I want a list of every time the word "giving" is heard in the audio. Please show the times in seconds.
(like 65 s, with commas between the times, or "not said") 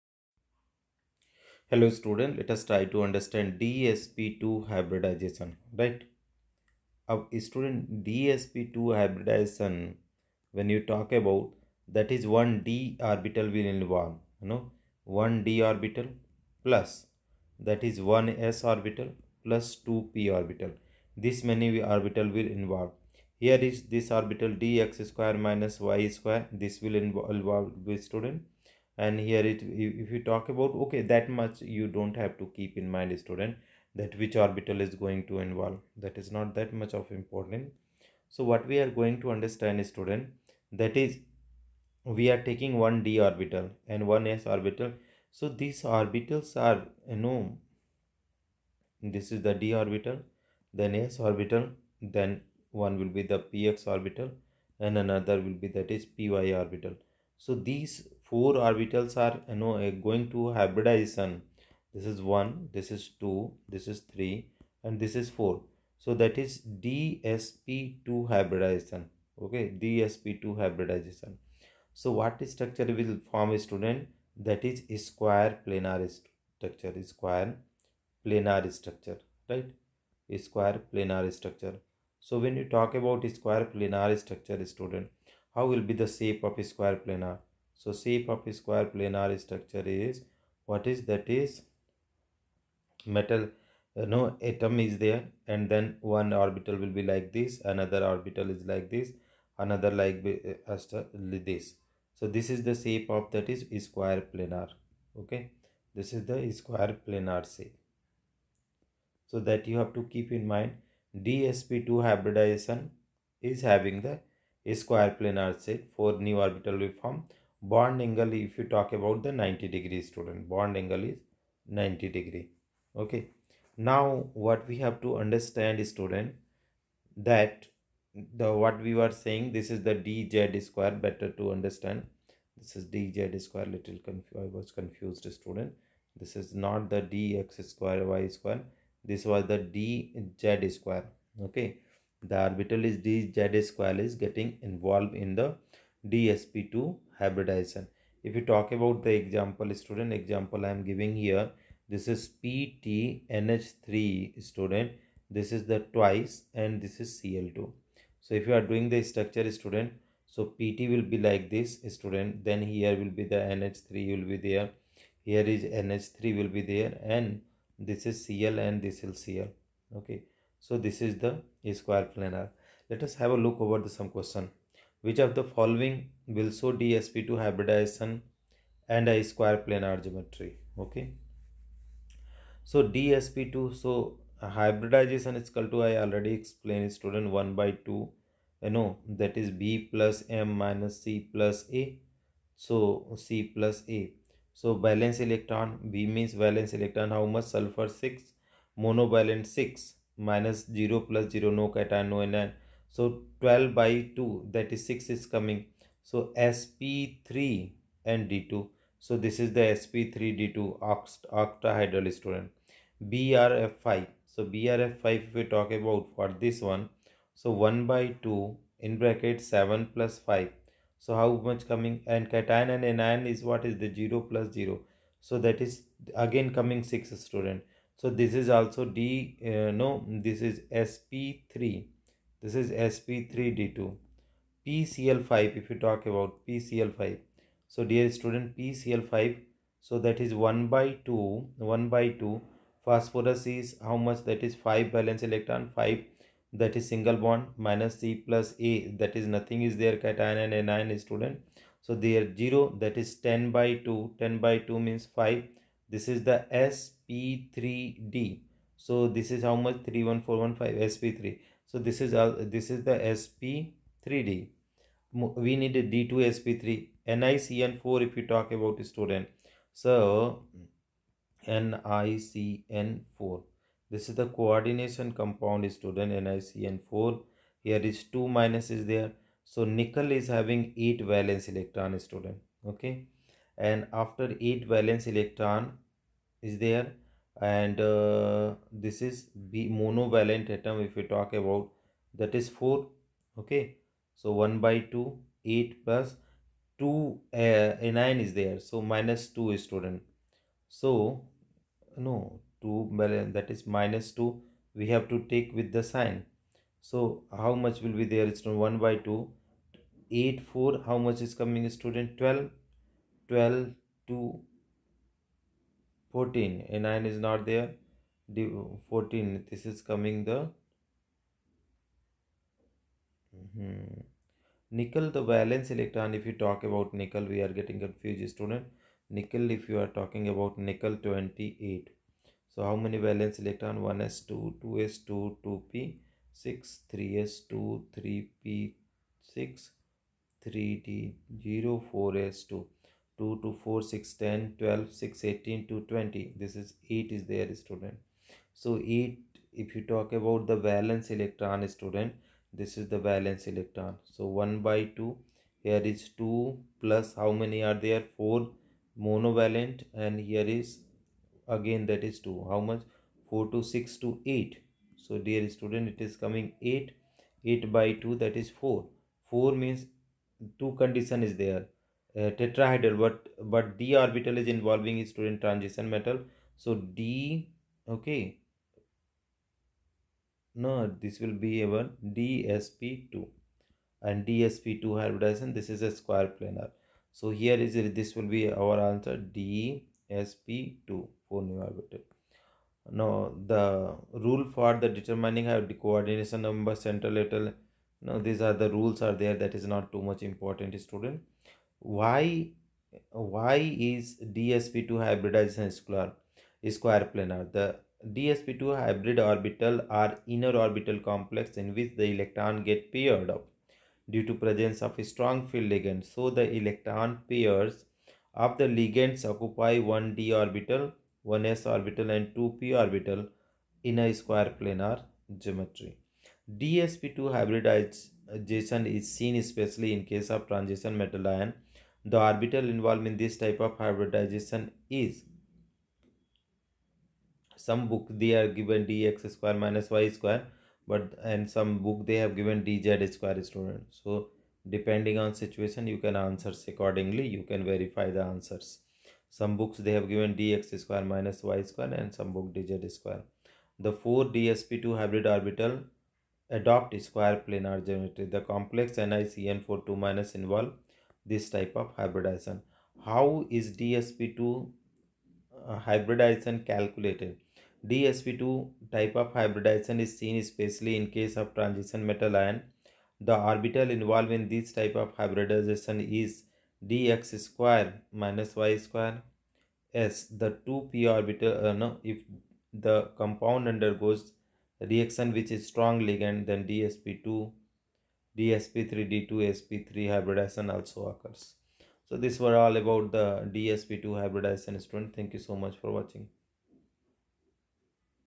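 150 s.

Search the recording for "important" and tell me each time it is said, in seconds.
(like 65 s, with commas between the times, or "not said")
37 s, 400 s.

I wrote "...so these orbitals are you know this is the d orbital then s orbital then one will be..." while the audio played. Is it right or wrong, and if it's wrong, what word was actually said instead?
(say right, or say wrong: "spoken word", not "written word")
right.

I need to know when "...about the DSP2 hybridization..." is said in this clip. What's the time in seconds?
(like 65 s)
492 s.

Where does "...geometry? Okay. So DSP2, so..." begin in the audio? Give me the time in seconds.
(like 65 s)
180 s.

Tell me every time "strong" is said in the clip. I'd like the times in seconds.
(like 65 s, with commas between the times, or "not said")
415 s, 485 s.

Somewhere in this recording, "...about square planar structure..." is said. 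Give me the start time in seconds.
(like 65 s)
83 s.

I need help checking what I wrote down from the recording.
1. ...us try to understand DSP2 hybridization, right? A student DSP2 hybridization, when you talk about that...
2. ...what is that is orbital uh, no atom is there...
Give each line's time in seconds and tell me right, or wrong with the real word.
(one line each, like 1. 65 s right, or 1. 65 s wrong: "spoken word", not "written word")
1. 2 s right
2. 90 s wrong: "metal", not "orbital".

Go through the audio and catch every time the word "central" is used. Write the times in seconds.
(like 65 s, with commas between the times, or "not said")
396 s.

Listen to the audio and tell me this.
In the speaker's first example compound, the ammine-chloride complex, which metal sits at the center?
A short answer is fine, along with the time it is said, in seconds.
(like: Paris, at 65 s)
Pt, at 160 s.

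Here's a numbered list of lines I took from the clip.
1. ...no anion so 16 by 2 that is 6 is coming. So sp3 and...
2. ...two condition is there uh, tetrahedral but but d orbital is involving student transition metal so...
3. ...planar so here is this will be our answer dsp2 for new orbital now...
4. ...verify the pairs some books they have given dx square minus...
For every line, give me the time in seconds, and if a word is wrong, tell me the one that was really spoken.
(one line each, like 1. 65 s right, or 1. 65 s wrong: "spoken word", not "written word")
1. 202 s wrong: "12", not "16"
2. 370 s right
3. 386 s right
4. 447 s wrong: "answers", not "pairs".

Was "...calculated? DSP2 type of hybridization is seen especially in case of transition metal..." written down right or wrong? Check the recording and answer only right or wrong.
right.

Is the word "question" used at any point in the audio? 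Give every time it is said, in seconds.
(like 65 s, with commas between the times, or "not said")
174 s.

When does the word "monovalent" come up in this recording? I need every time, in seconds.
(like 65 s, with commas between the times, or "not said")
198 s, 289 s, 359 s.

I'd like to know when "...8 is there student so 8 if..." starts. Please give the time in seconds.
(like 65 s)
346 s.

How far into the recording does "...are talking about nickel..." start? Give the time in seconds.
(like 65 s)
329 s.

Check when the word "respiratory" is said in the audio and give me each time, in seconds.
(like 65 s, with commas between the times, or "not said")
not said.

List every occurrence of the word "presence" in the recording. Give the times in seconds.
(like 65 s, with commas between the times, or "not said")
414 s.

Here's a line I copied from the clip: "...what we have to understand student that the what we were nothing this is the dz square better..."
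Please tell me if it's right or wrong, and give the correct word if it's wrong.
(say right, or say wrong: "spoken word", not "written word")
wrong: "saying", not "nothing".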